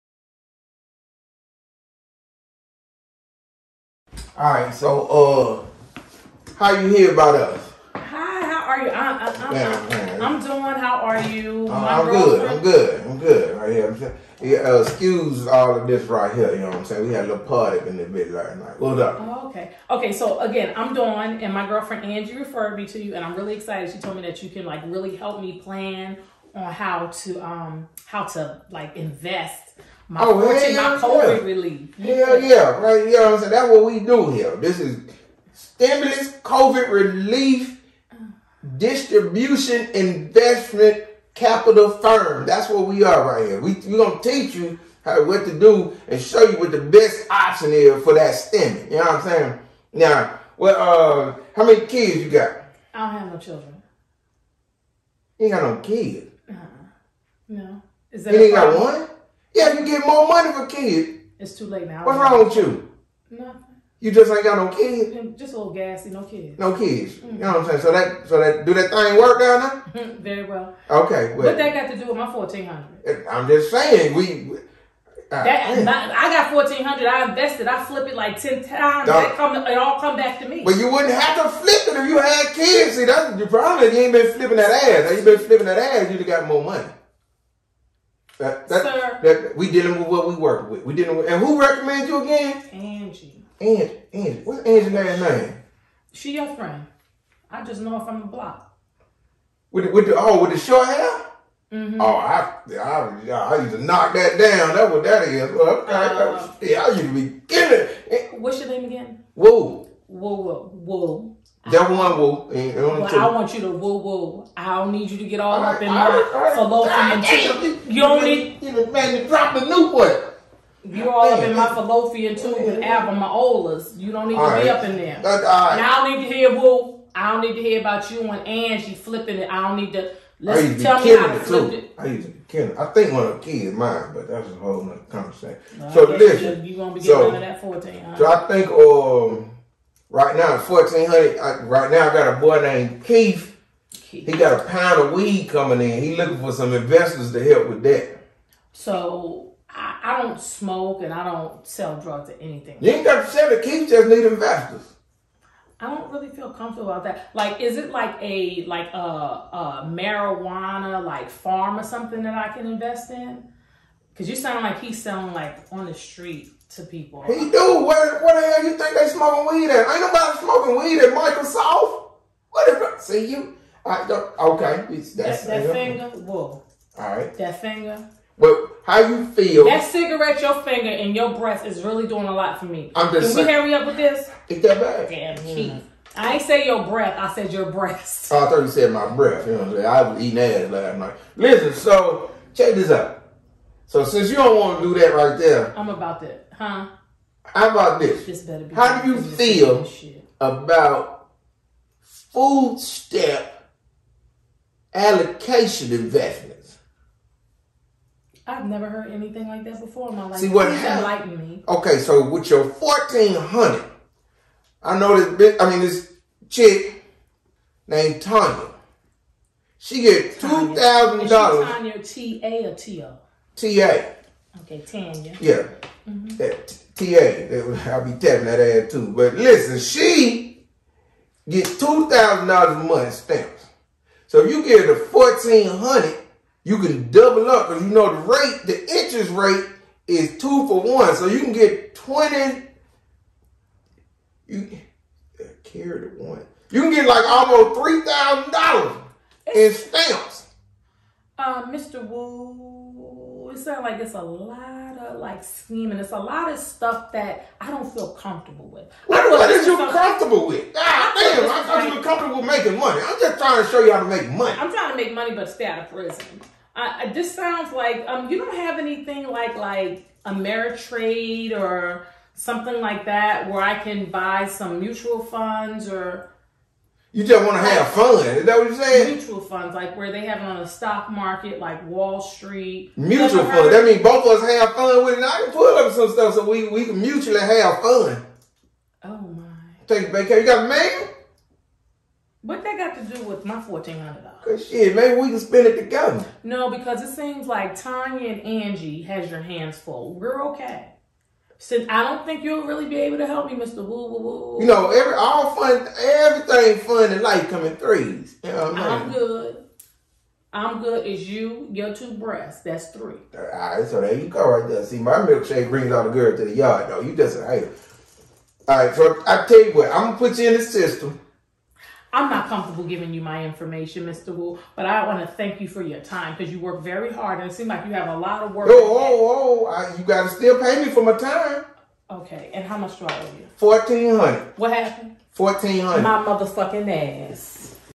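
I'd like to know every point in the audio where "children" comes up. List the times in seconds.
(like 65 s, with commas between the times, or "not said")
53 s.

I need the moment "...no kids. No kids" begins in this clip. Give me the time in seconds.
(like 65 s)
66 s.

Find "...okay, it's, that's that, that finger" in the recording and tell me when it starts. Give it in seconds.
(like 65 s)
174 s.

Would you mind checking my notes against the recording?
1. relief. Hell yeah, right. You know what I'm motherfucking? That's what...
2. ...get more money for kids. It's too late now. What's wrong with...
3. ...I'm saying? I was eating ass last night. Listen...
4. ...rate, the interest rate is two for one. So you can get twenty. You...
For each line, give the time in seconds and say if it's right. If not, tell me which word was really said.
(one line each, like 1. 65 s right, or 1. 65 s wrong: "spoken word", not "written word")
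1. 31 s wrong: "saying", not "motherfucking"
2. 59 s right
3. 189 s right
4. 238 s right.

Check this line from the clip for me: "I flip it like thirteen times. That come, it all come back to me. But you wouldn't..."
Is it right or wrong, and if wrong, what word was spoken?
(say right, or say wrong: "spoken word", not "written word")
wrong: "ten", not "thirteen".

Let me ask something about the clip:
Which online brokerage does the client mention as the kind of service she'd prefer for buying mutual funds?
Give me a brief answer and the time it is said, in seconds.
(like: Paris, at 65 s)
Ameritrade, at 270 s.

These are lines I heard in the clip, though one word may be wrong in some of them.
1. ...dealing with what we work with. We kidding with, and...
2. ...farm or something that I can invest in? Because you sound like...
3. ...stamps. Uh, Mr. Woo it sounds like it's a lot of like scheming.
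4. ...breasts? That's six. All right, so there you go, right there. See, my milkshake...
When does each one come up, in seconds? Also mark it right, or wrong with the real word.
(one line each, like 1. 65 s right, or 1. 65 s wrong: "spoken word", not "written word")
1. 89 s wrong: "dealing", not "kidding"
2. 161 s right
3. 249 s right
4. 312 s wrong: "three", not "six".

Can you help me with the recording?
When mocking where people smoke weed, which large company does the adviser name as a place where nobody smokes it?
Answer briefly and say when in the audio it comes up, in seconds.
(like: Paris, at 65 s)
Microsoft, at 171 s.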